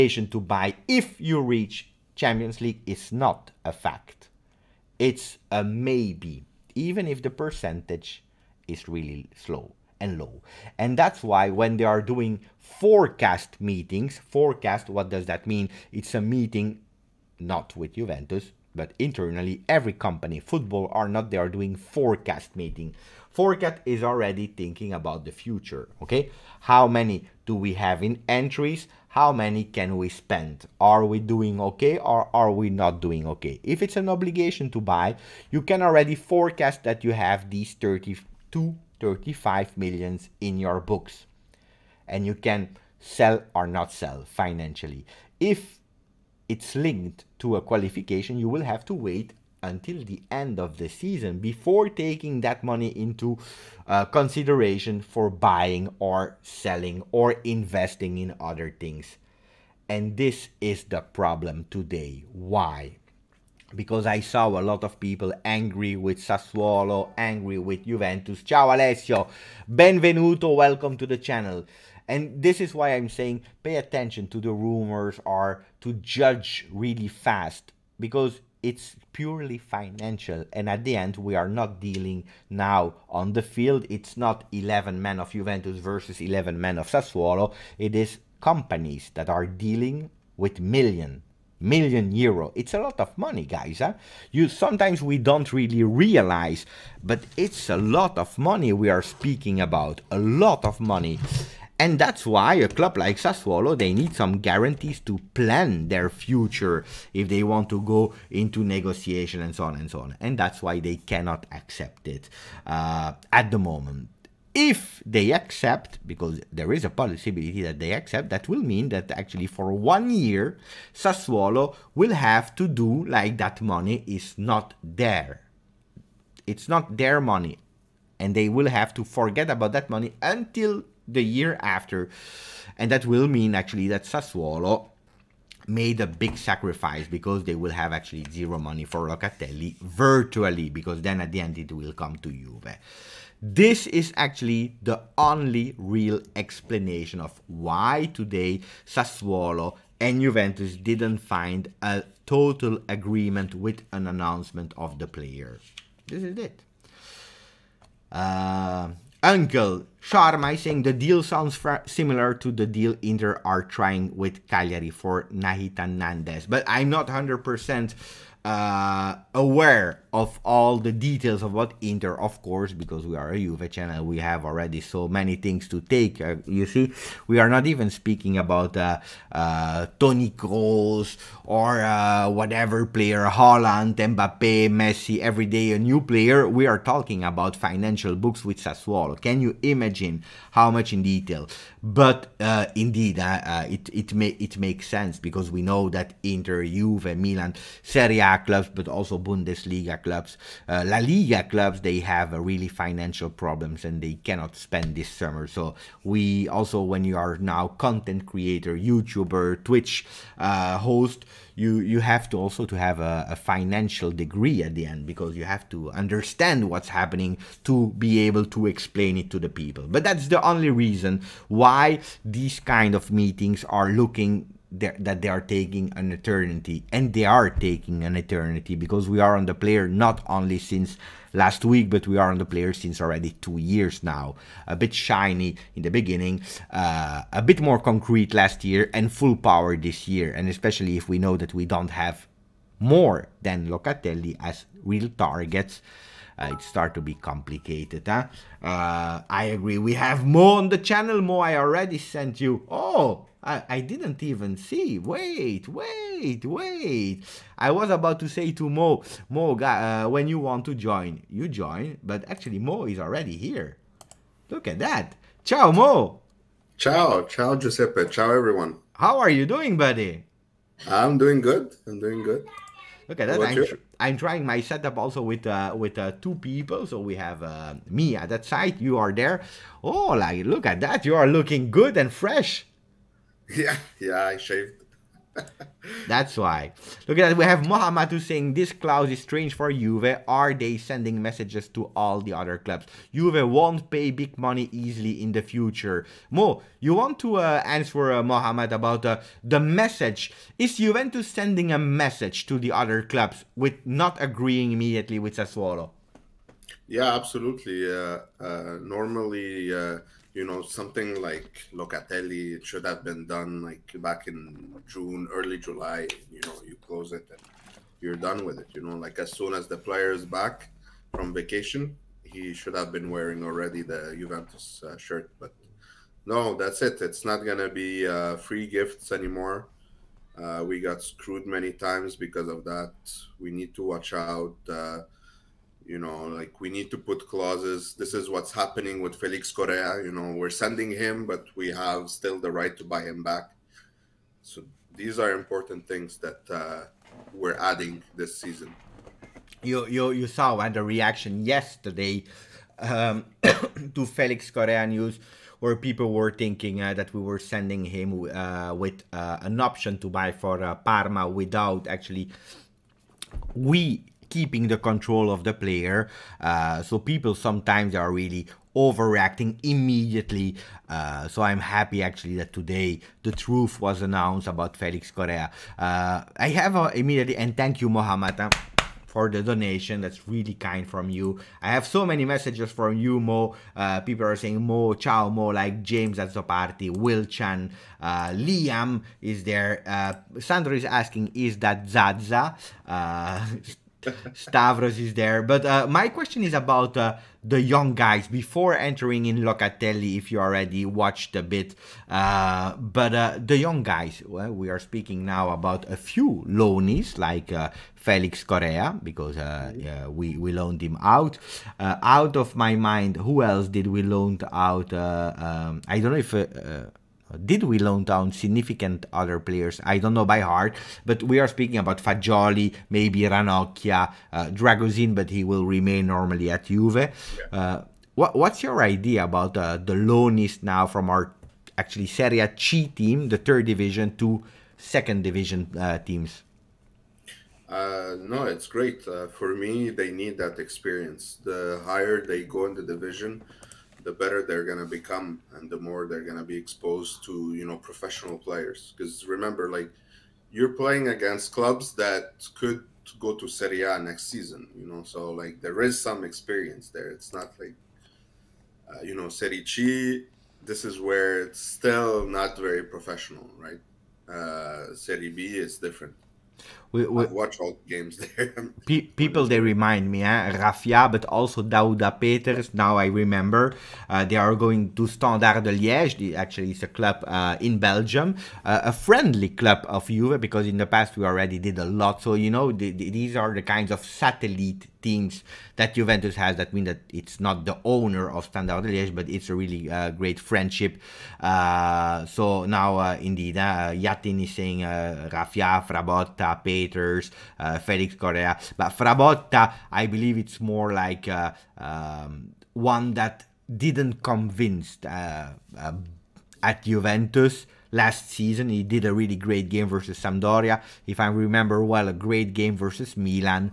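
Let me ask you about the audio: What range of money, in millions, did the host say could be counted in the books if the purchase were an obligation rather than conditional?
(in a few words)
32-35 million.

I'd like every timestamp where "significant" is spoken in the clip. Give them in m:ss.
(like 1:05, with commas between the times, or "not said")
6:58.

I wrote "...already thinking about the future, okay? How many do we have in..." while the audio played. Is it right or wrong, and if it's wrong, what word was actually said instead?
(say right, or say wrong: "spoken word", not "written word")
right.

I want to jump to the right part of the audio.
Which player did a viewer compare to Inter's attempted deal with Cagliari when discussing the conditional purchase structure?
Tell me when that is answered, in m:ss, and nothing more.
2:45.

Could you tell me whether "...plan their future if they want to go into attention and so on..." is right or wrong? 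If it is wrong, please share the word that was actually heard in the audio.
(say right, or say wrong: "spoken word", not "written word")
wrong: "negotiation", not "attention".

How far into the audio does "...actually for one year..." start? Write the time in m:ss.
1:59.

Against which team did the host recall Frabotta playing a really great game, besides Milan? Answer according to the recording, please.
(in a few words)
Sampdoria.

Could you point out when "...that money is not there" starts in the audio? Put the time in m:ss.
2:03.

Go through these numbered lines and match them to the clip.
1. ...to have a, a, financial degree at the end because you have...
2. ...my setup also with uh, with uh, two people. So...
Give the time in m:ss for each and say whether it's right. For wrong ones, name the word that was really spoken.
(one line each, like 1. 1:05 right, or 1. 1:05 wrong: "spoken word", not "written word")
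1. 3:32 right
2. 4:34 right.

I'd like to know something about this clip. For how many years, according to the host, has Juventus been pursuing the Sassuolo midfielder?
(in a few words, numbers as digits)
2.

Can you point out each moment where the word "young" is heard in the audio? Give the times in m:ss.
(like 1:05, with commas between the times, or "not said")
6:37, 6:43.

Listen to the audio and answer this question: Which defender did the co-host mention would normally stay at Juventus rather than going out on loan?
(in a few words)
Dragusin.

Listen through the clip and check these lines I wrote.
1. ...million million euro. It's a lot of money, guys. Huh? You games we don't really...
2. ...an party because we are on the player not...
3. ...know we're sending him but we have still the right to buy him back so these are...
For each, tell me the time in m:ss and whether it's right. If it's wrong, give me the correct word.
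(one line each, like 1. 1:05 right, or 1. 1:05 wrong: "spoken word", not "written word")
1. 1:30 wrong: "sometimes", not "games"
2. 3:48 wrong: "eternity", not "party"
3. 5:40 right.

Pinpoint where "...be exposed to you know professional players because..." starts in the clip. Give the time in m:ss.
7:26.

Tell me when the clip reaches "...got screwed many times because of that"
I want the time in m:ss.
5:30.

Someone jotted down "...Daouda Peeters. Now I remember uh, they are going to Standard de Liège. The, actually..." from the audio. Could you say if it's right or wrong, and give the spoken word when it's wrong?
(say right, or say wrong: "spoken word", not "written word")
right.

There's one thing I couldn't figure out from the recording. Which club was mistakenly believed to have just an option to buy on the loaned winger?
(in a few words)
Parma.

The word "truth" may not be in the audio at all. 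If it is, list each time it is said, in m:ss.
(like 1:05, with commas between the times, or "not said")
6:13.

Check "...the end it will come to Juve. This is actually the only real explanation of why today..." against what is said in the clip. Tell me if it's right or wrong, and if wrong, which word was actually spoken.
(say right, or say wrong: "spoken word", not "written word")
right.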